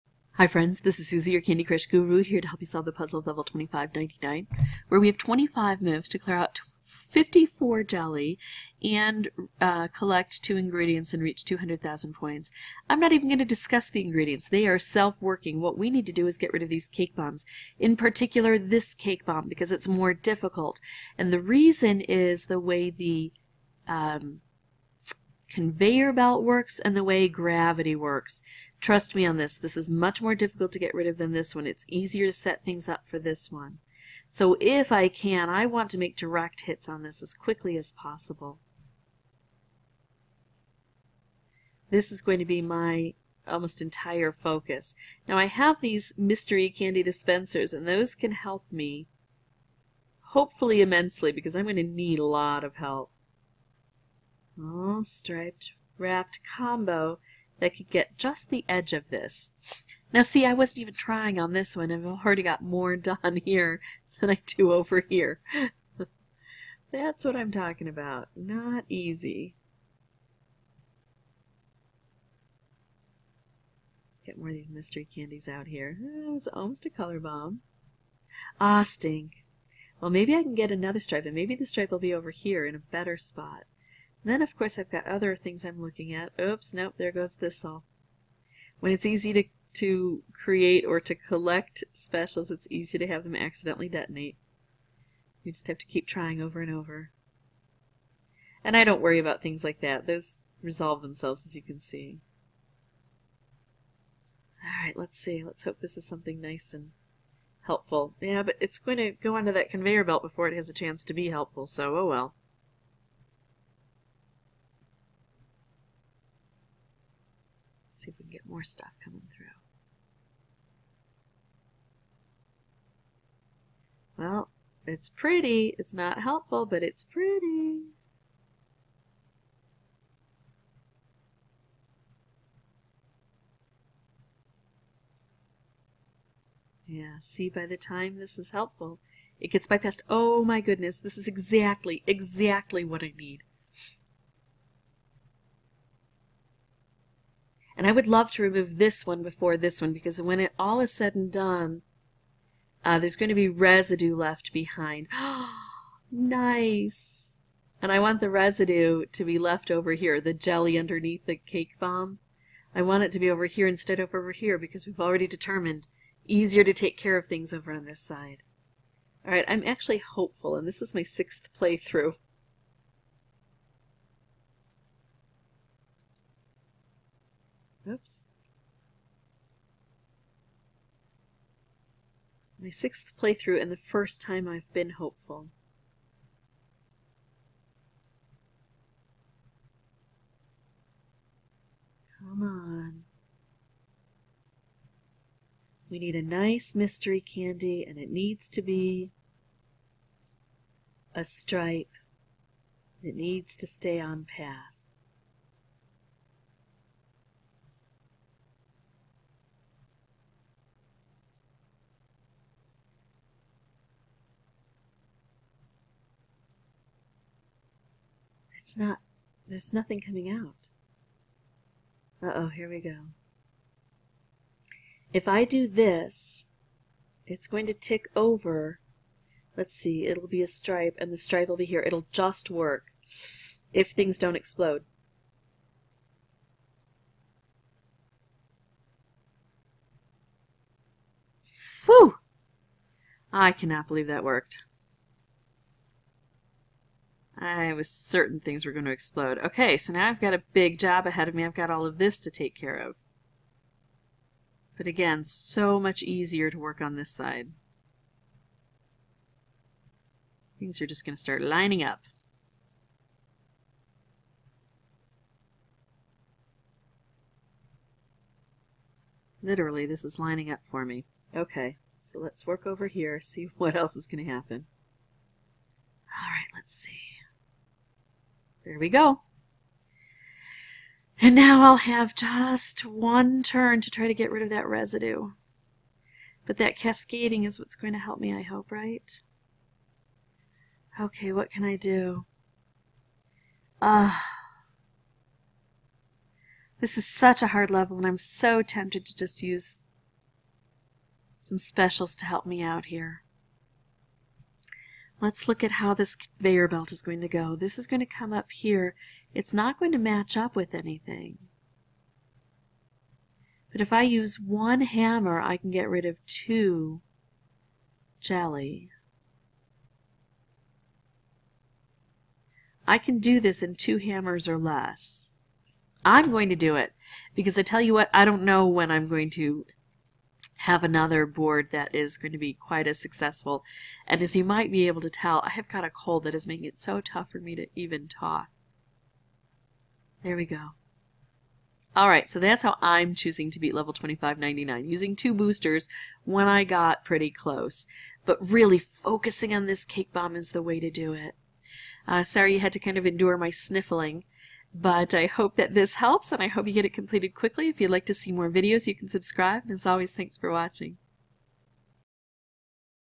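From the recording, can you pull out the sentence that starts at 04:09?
Okay, so now I've got a big job ahead of me.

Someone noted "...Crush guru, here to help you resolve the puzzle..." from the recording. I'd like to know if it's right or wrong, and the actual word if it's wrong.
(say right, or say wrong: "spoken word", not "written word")
wrong: "solve", not "resolve".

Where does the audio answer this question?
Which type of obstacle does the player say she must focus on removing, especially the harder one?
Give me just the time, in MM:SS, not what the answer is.
00:16.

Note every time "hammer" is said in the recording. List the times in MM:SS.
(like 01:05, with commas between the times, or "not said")
05:14, 05:23.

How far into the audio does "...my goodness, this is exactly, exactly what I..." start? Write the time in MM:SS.
02:20.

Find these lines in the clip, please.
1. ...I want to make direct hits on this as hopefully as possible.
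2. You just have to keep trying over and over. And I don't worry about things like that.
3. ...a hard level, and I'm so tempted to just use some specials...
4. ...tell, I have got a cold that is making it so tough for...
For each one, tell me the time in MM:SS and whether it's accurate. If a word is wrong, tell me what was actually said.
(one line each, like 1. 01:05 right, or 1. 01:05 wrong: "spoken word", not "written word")
1. 00:35 wrong: "quickly", not "hopefully"
2. 01:35 right
3. 04:57 right
4. 05:35 right.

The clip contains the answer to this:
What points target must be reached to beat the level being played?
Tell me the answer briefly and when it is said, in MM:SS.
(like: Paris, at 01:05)
200,000, at 00:11.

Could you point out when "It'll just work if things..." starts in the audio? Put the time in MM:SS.
03:51.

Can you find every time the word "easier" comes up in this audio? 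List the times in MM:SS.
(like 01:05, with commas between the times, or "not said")
00:31, 02:46, 04:16.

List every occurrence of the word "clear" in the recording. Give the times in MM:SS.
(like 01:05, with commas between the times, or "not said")
00:06.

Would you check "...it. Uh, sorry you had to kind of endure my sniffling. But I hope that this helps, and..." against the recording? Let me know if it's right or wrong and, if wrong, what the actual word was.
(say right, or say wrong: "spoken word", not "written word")
right.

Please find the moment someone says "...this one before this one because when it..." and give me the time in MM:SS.
02:28.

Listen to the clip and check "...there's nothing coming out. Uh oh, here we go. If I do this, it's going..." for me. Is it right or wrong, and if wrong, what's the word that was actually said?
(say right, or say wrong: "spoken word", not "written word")
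right.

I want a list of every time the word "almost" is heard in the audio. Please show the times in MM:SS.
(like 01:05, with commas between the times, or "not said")
00:43, 01:16.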